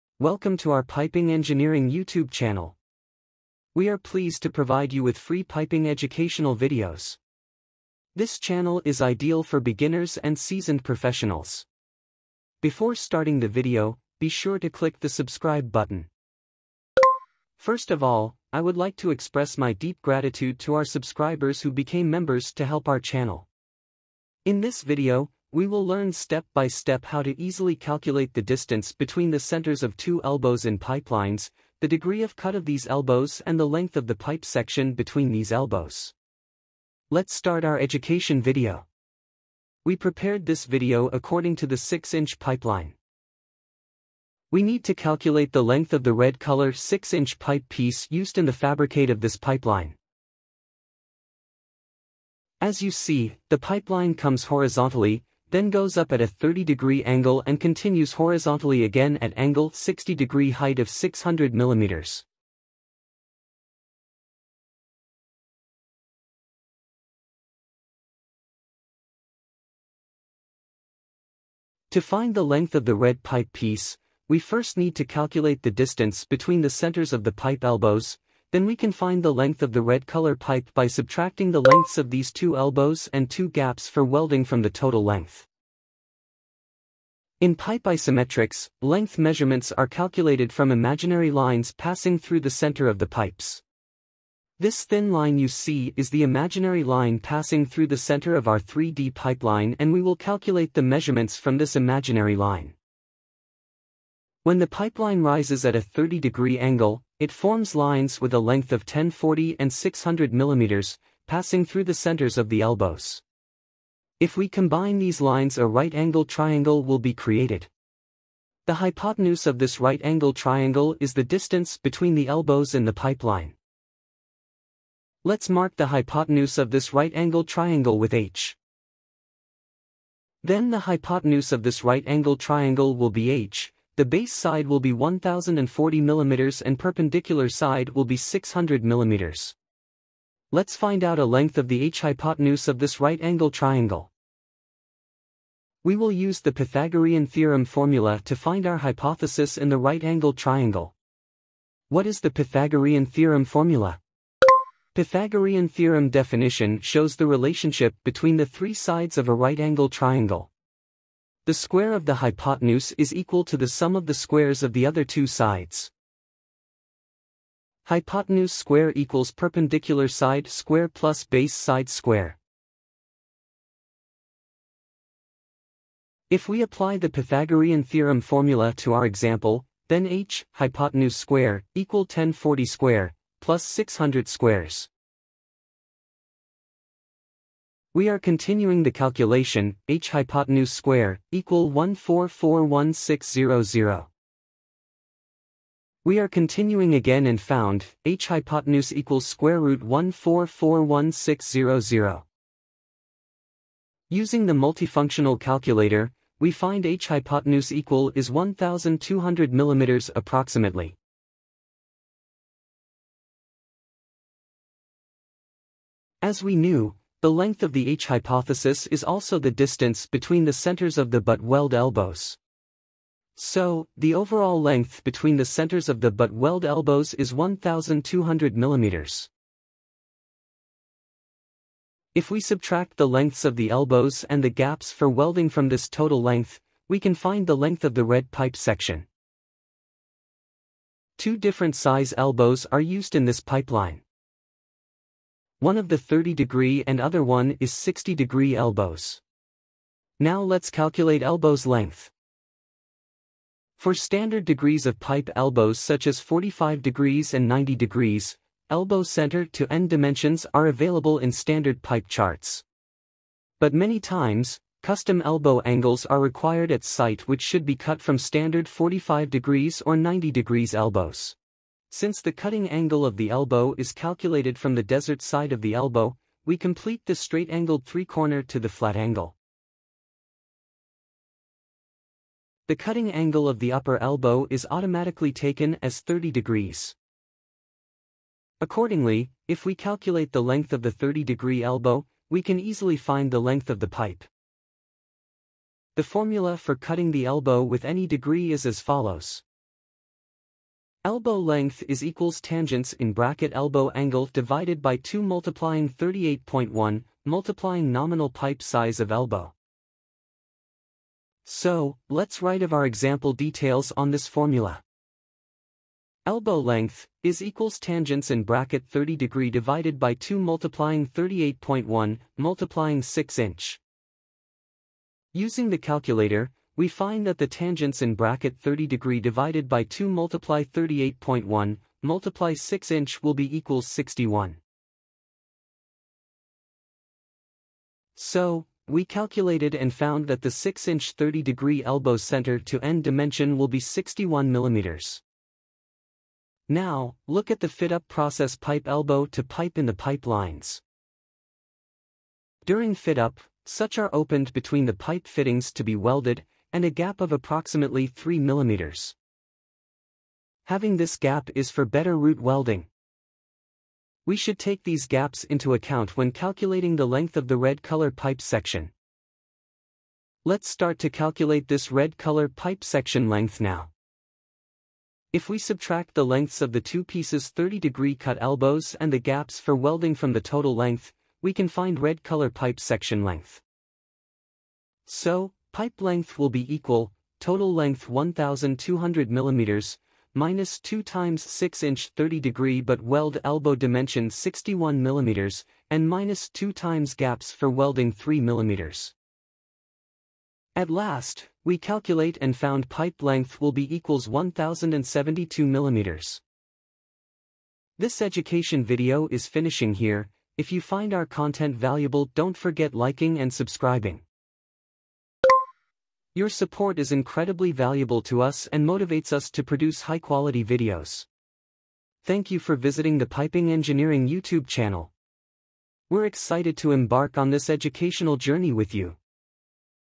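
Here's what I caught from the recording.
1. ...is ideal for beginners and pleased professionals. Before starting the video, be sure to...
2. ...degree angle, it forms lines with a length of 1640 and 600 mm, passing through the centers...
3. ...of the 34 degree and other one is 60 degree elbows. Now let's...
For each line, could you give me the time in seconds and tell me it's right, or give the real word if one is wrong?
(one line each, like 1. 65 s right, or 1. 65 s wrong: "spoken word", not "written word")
1. 8 s wrong: "seasoned", not "pleased"
2. 106 s wrong: "1040", not "1640"
3. 245 s wrong: "30", not "34".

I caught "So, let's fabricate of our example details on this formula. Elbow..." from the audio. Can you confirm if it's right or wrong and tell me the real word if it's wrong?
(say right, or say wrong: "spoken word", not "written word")
wrong: "write", not "fabricate".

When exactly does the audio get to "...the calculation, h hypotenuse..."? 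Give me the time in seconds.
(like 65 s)
188 s.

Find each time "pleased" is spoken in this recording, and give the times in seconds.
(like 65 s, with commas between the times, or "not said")
3 s.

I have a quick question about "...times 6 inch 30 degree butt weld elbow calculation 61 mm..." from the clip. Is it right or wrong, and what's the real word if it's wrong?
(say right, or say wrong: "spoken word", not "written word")
wrong: "dimension", not "calculation".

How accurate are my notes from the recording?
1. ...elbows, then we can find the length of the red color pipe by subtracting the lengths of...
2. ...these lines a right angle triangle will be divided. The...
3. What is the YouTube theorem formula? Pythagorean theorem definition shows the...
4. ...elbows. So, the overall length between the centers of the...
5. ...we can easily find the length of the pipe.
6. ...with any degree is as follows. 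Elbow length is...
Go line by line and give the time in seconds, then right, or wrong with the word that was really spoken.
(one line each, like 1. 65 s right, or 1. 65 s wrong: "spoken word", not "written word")
1. 77 s right
2. 114 s wrong: "created", not "divided"
3. 151 s wrong: "Pythagorean", not "YouTube"
4. 221 s right
5. 292 s right
6. 297 s right.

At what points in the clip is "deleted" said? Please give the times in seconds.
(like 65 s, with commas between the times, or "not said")
not said.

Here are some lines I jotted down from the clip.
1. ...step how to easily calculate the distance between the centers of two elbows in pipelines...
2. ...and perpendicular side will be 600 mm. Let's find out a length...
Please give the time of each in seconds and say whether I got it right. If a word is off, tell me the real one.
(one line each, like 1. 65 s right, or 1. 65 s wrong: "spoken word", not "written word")
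1. 26 s right
2. 136 s right.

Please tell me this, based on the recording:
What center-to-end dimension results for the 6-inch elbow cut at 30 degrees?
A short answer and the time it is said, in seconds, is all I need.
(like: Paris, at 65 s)
61 mm, at 343 s.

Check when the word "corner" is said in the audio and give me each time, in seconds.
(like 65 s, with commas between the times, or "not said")
277 s.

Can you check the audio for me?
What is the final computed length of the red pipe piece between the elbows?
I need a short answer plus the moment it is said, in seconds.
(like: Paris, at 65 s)
1072 mm, at 404 s.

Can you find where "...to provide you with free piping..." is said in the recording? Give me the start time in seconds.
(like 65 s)
4 s.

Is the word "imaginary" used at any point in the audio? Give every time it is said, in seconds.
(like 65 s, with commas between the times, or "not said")
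90 s, 96 s, 101 s.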